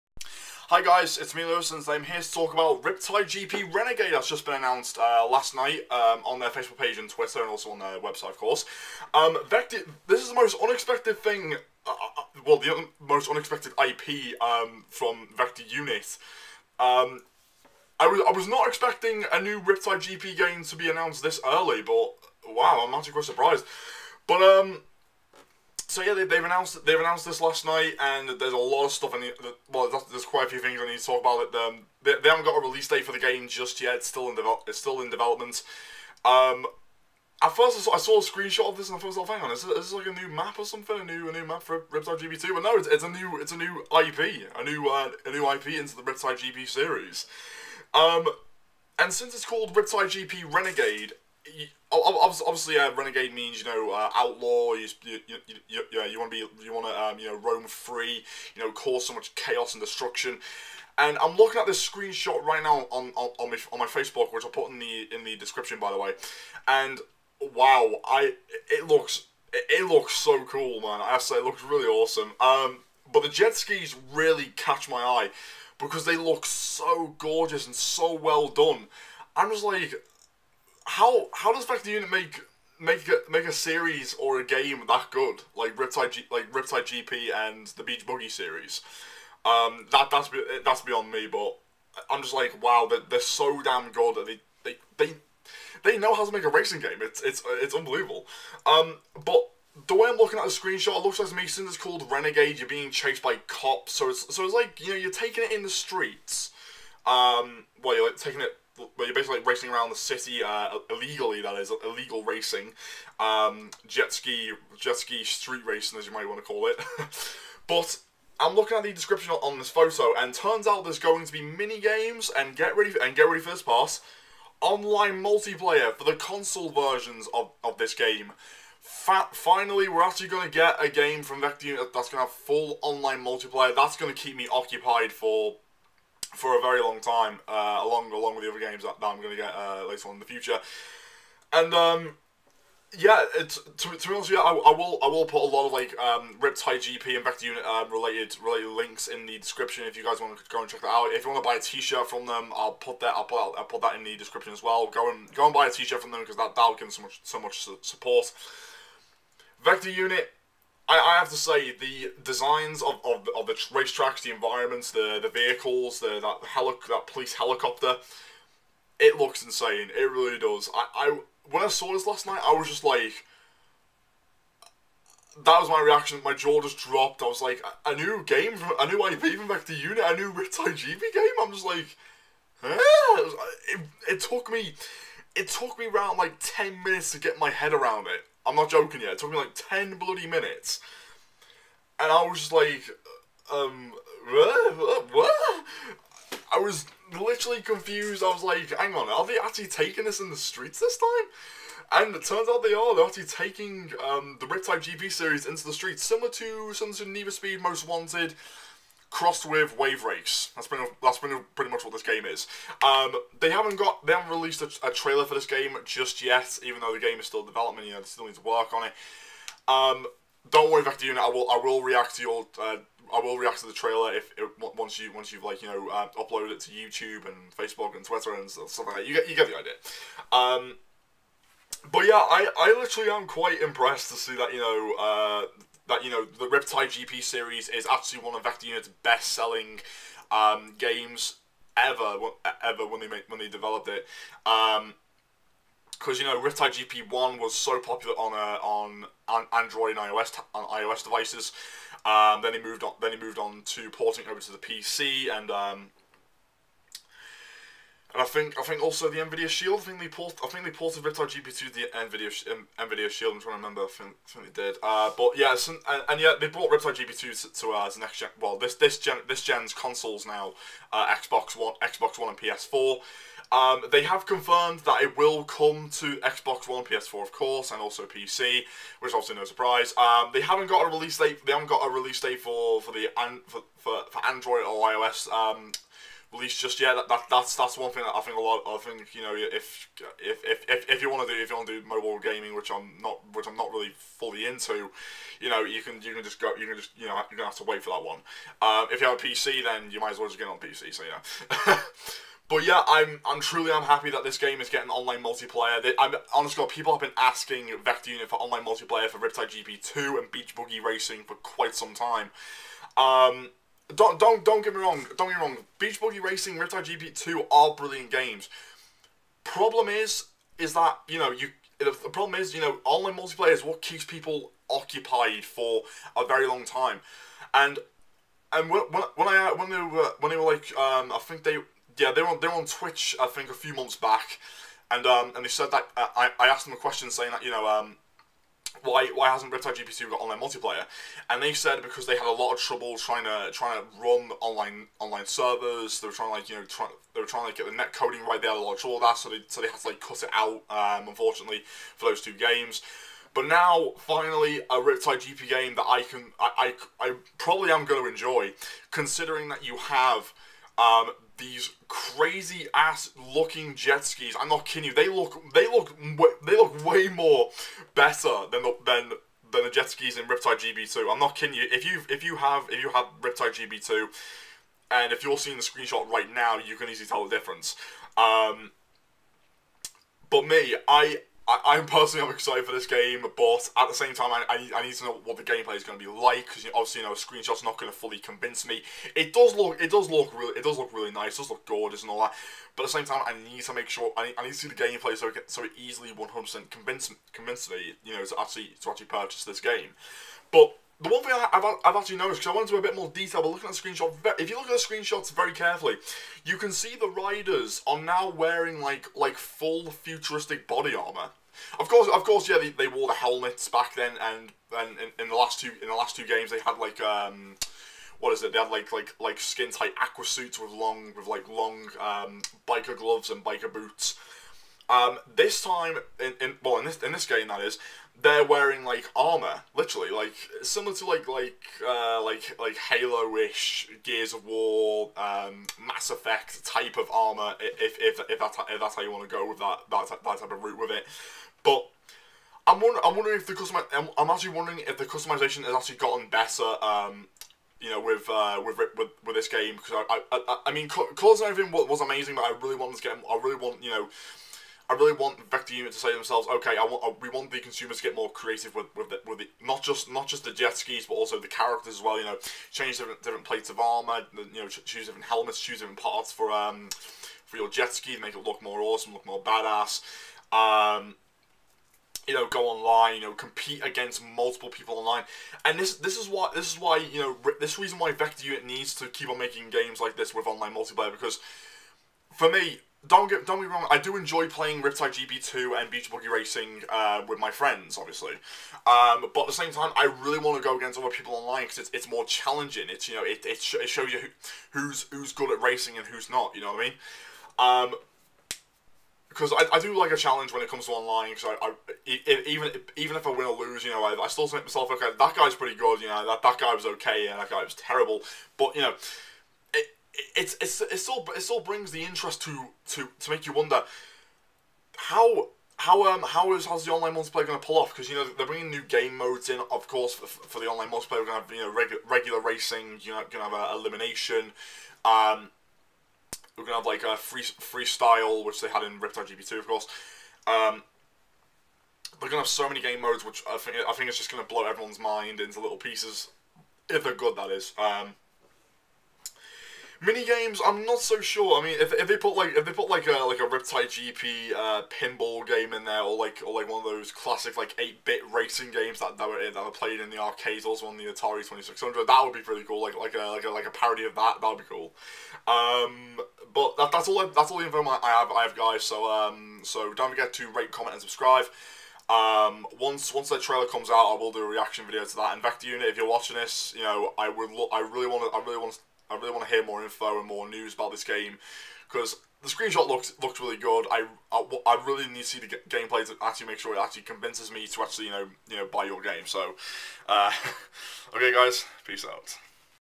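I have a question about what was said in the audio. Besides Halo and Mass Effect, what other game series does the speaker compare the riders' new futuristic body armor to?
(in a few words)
Gears of War.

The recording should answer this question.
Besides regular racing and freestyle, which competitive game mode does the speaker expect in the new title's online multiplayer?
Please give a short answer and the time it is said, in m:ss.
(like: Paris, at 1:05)
Elimination, at 8:43.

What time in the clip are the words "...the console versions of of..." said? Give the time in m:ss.
2:06.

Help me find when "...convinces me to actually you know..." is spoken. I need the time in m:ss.
9:37.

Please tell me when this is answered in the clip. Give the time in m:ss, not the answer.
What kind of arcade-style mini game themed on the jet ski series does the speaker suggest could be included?
9:04.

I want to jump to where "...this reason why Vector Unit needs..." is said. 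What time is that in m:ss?
7:57.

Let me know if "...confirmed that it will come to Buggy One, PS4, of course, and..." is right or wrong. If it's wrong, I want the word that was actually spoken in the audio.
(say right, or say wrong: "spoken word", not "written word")
wrong: "Xbox", not "Buggy".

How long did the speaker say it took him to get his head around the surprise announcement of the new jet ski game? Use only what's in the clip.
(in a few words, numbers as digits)
10 minutes.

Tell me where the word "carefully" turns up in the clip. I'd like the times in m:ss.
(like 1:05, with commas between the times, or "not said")
6:45.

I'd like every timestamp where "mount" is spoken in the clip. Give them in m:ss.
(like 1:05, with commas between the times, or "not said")
not said.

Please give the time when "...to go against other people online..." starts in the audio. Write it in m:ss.
8:10.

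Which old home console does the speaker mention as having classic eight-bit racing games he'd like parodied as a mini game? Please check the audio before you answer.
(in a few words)
Atari 2600.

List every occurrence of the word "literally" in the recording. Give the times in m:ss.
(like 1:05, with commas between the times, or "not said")
3:17, 3:52, 7:09.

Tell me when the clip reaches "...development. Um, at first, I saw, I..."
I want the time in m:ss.
0:35.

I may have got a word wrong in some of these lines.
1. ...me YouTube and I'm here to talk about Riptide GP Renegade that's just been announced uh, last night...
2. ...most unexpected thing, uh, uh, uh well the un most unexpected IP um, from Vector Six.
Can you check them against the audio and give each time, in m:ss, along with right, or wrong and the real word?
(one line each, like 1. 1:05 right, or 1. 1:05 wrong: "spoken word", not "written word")
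1. 0:01 wrong: "Lewis", not "YouTube"
2. 0:10 wrong: "Unit", not "Six".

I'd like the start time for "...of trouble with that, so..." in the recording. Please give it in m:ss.
5:48.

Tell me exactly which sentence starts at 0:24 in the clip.
But um, so yeah, they, they've announced they've announced this last night, and there's a lot of stuff.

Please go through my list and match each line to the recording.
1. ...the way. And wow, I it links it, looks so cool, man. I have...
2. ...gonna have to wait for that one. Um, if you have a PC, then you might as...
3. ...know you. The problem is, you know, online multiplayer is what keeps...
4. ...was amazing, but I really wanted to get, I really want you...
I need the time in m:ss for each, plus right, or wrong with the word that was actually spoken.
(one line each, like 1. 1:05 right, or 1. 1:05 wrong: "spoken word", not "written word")
1. 1:05 wrong: "looks", not "links"
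2. 4:57 right
3. 5:21 right
4. 7:31 right.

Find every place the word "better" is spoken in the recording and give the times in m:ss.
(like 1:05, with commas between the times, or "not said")
6:07, 7:26.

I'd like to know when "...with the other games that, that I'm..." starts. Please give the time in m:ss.
2:18.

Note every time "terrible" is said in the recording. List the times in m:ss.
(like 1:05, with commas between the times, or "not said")
8:27.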